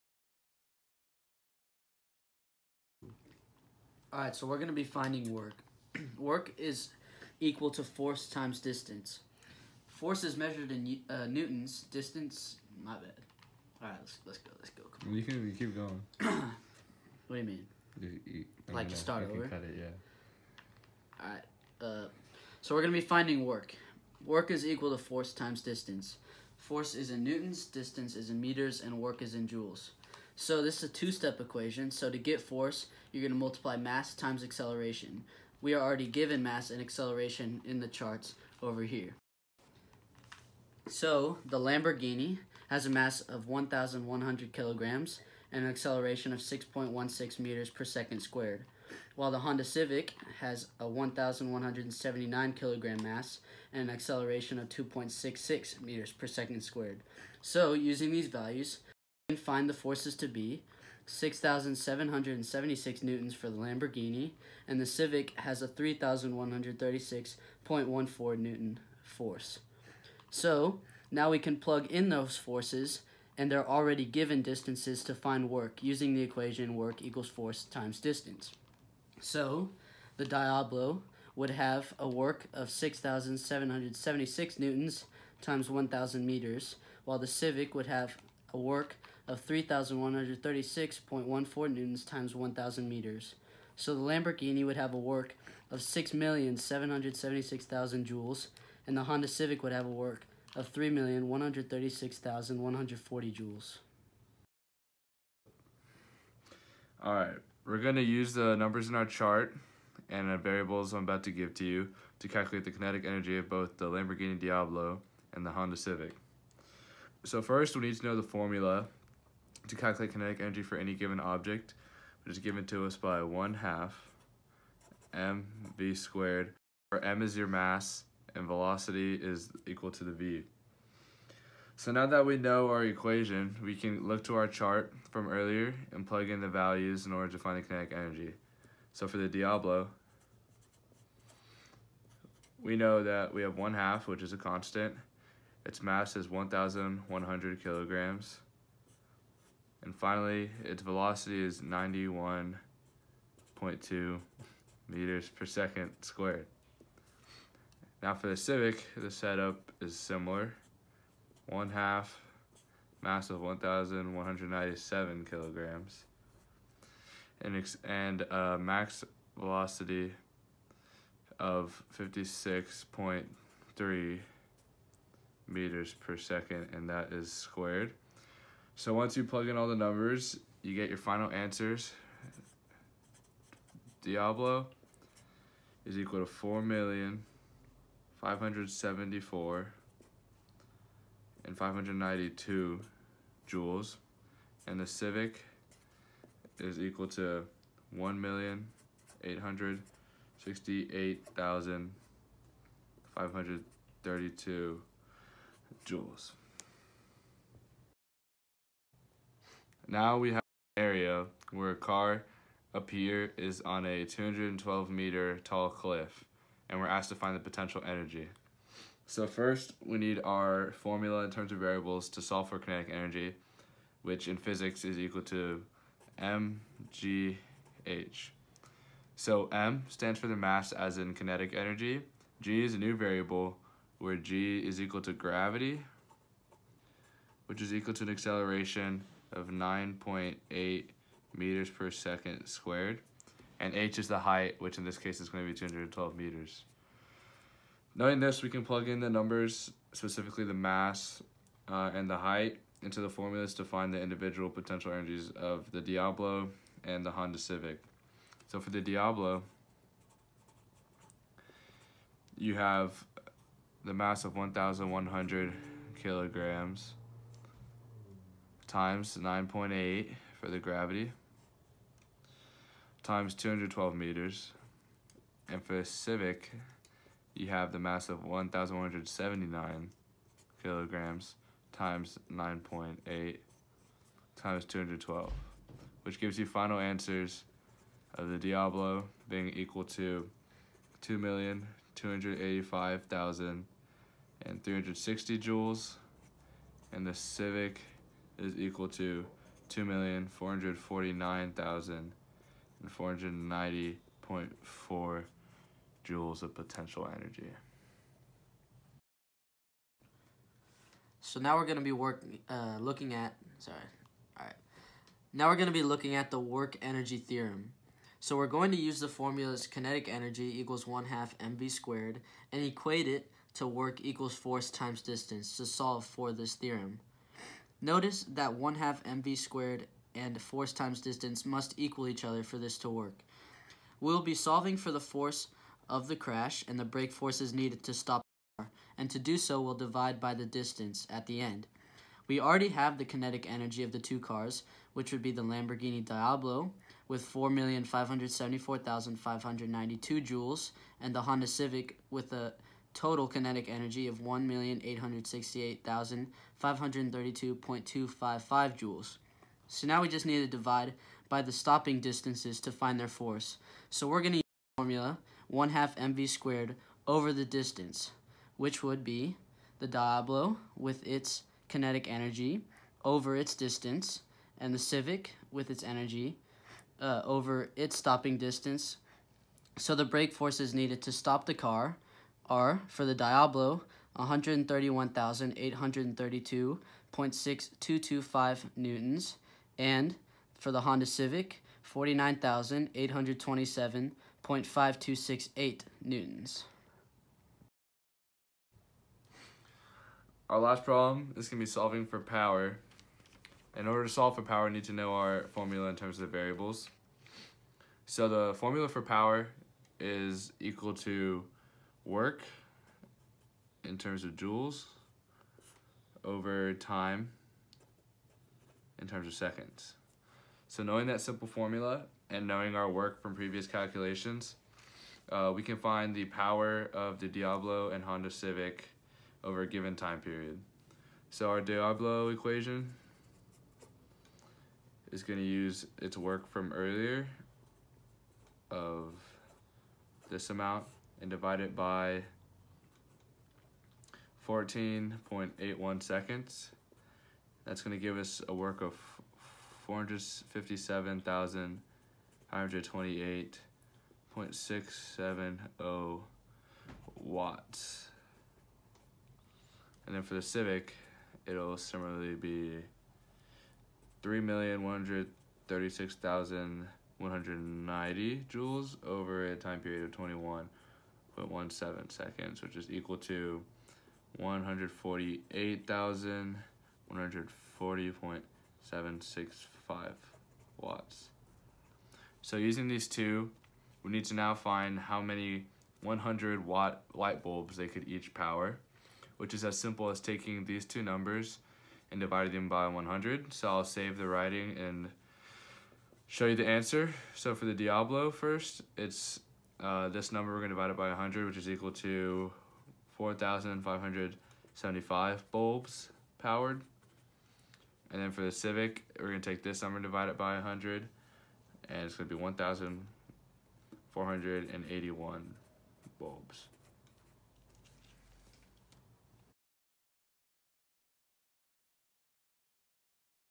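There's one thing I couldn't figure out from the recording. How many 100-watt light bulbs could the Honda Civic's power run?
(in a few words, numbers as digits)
1,481.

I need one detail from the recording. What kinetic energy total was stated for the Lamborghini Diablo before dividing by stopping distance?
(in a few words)
4,574,592 joules.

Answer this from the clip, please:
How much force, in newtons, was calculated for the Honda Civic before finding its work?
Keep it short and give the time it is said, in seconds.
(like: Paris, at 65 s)
3,136.14 newtons, at 65 s.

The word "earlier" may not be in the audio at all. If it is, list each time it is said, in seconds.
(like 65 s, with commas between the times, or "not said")
135 s, 436 s.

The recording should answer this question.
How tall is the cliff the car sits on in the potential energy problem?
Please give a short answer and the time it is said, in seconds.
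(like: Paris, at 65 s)
212 meters, at 214 s.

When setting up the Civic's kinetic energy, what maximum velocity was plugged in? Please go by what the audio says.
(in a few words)
56.3 m/s.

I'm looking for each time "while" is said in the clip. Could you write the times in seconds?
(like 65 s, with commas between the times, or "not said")
49 s, 87 s.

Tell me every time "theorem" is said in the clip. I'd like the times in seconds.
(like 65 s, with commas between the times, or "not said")
317 s, 326 s.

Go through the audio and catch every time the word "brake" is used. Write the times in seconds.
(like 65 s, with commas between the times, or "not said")
336 s, 380 s.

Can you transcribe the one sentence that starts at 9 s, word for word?
Force is measured in uh, newtons.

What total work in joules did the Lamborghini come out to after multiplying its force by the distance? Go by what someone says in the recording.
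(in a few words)
6,776,000 joules.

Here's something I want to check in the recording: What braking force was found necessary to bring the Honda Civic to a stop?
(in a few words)
49,827.5268 newtons.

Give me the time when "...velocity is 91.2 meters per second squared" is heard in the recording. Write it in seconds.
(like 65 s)
150 s.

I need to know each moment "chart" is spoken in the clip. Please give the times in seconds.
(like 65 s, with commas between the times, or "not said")
37 s, 109 s, 134 s.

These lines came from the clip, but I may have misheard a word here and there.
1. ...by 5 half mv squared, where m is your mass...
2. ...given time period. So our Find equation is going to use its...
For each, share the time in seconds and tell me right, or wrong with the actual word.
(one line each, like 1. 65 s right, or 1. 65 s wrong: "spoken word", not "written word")
1. 122 s wrong: "1", not "5"
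2. 429 s wrong: "Diablo", not "Find".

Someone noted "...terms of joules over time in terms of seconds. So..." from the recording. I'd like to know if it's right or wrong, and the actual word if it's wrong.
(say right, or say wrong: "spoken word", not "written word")
right.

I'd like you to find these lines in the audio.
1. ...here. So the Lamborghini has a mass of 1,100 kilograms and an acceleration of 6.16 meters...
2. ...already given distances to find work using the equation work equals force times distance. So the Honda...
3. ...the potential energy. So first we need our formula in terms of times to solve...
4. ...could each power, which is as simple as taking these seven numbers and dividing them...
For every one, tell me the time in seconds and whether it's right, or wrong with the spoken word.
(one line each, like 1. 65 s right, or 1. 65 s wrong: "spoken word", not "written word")
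1. 38 s right
2. 73 s wrong: "Diablo", not "Honda"
3. 217 s wrong: "variables", not "times"
4. 487 s wrong: "two", not "seven".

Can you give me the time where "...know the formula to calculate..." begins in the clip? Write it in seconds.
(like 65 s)
118 s.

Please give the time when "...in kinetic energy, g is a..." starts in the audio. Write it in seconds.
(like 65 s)
230 s.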